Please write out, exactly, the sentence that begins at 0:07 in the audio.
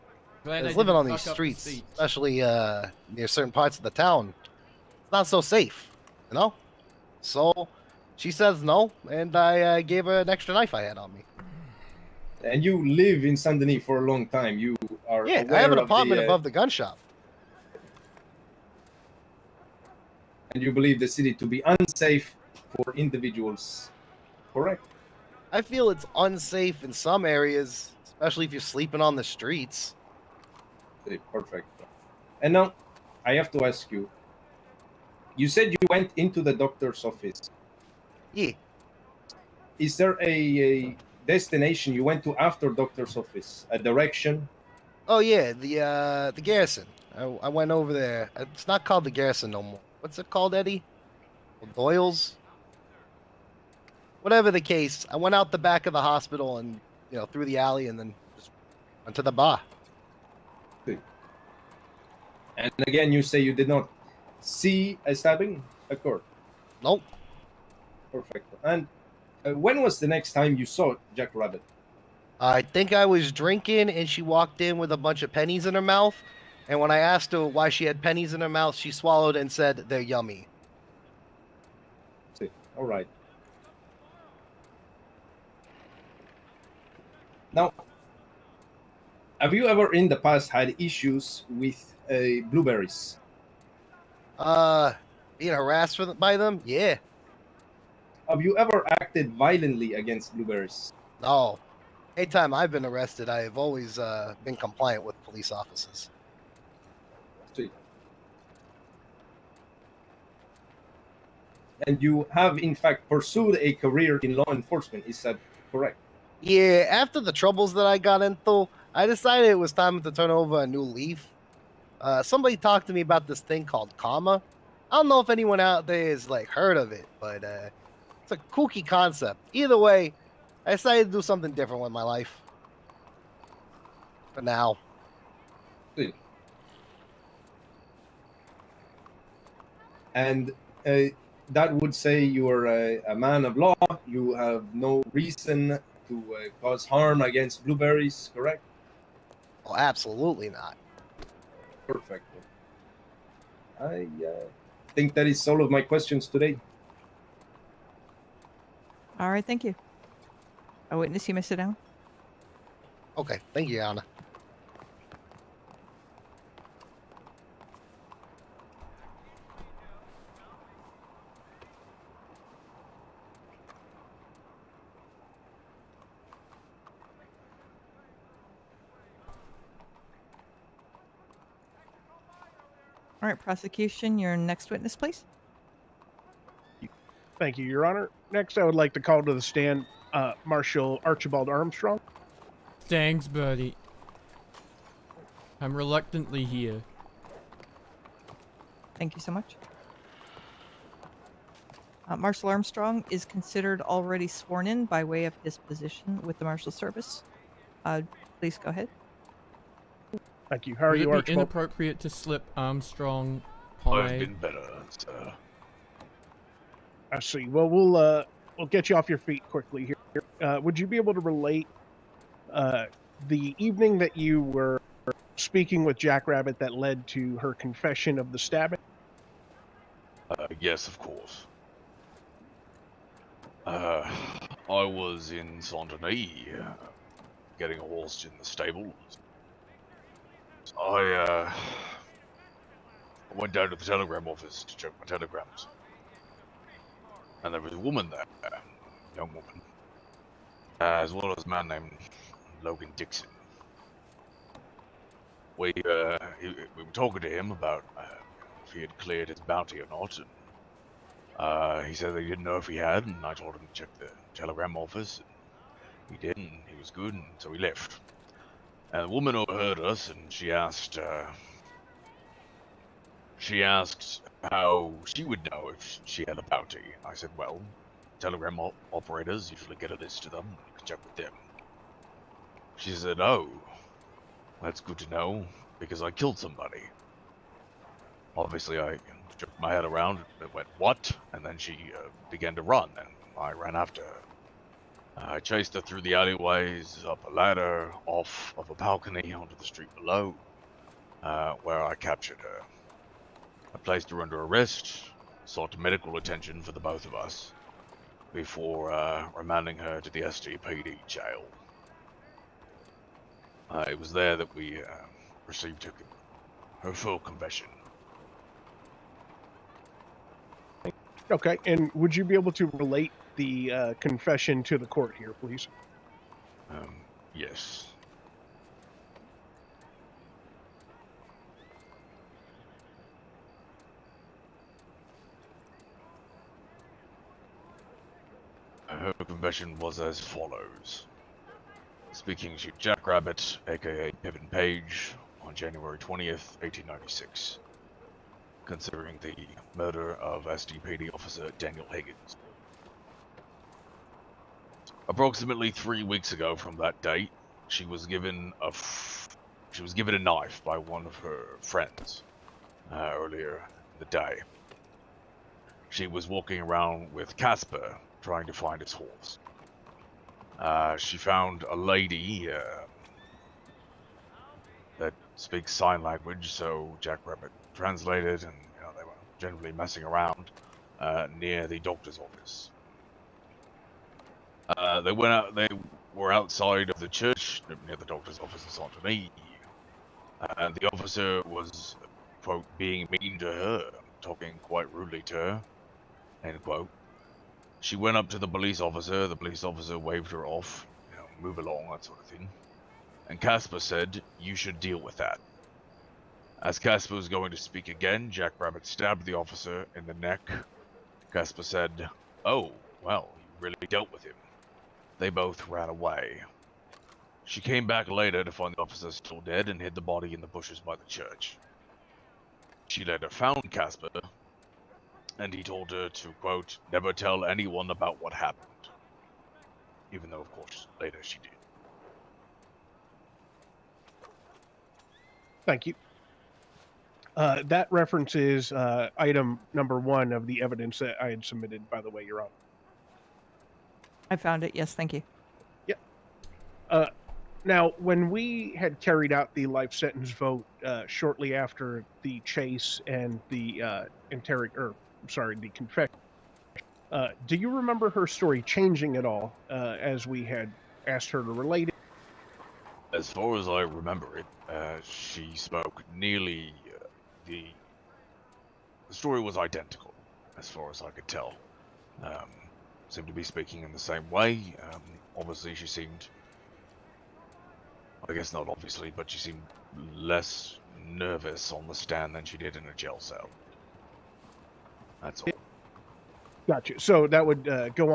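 So she says no, and I uh, gave her an extra knife I had on me.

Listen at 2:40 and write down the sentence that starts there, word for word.
A witness, you may sit down.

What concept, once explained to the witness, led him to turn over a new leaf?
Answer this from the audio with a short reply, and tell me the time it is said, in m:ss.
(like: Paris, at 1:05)
Karma, at 2:03.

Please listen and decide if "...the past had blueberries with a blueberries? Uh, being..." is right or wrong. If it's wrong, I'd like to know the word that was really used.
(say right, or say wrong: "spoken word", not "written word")
wrong: "issues", not "blueberries".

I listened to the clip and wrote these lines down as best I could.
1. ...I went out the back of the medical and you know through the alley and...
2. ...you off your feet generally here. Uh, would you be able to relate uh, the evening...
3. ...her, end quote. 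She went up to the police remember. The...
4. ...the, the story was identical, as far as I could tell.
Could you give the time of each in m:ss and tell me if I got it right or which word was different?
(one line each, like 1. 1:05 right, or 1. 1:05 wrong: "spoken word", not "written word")
1. 0:55 wrong: "hospital", not "medical"
2. 3:38 wrong: "quickly", not "generally"
3. 6:35 wrong: "officer", not "remember"
4. 7:47 right.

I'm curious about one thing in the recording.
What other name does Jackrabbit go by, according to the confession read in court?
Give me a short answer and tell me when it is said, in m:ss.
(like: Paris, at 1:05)
Pippin Page, at 5:44.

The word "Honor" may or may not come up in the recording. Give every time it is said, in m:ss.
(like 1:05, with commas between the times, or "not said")
3:07, 7:22.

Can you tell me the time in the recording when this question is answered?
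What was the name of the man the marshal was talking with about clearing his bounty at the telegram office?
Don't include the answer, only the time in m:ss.
4:12.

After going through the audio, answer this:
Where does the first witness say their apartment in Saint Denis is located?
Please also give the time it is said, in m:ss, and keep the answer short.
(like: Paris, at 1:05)
Above the gun shop, at 0:16.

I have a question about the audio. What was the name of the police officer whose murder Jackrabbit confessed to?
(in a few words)
Daniel Higgins.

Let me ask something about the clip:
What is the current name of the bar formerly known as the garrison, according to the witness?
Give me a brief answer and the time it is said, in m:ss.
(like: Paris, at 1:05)
Doyle's, at 0:51.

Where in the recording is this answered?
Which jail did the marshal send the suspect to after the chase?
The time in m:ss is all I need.
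5:10.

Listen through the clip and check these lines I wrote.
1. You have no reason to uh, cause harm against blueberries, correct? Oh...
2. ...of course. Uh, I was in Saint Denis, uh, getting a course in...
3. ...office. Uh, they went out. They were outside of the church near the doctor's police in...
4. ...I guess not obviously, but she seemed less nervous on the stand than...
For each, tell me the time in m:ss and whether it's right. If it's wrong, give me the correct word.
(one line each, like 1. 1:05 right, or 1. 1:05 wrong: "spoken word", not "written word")
1. 2:24 right
2. 3:50 wrong: "horse", not "course"
3. 6:22 wrong: "office", not "police"
4. 7:58 right.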